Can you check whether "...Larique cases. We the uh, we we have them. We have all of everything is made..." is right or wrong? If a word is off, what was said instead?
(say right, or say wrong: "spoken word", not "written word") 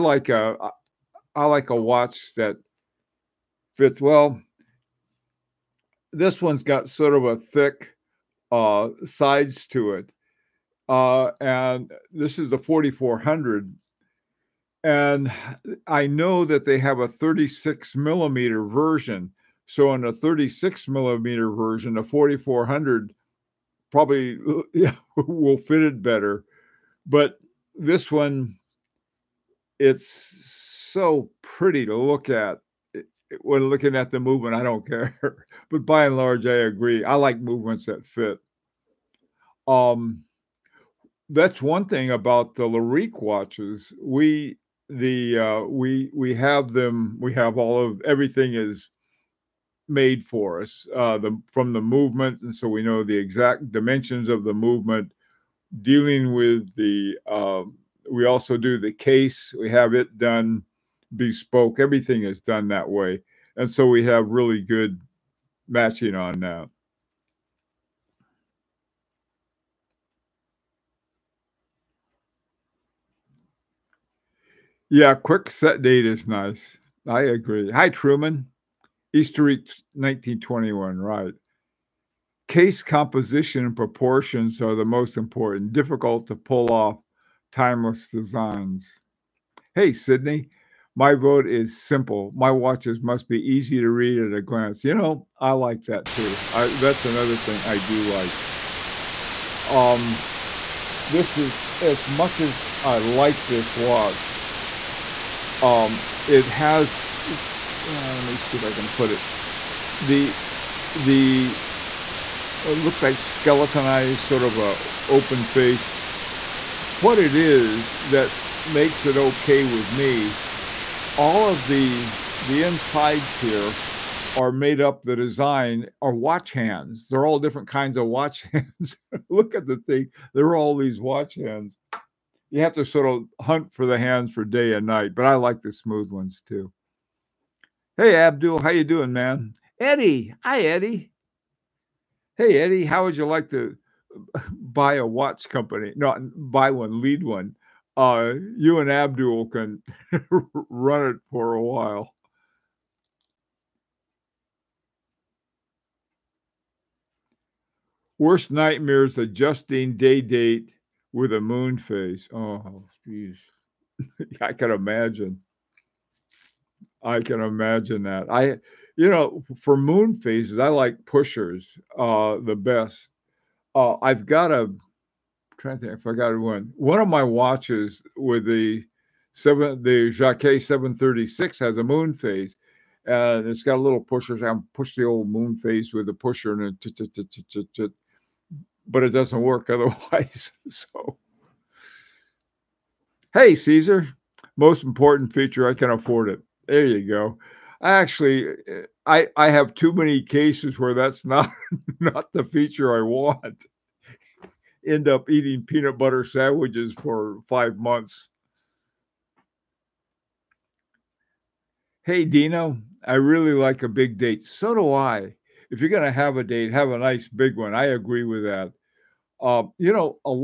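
wrong: "watches", not "cases".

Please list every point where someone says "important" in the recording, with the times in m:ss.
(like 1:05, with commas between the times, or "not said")
1:25, 3:14.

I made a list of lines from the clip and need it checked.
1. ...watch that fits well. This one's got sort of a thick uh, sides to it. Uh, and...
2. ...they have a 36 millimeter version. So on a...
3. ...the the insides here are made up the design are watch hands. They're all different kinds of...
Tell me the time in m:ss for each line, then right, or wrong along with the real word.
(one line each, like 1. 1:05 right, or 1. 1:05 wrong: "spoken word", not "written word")
1. 0:01 right
2. 0:16 right
3. 2:01 right.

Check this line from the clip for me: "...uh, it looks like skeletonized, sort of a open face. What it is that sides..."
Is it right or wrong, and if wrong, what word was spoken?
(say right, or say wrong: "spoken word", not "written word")
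wrong: "makes", not "sides".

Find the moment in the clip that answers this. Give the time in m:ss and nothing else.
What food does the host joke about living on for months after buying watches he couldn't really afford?
3:25.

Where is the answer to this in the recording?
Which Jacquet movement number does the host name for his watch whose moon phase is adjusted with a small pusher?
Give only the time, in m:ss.
3:00.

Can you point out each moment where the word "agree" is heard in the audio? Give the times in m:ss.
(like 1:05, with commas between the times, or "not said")
0:36, 1:17, 3:37.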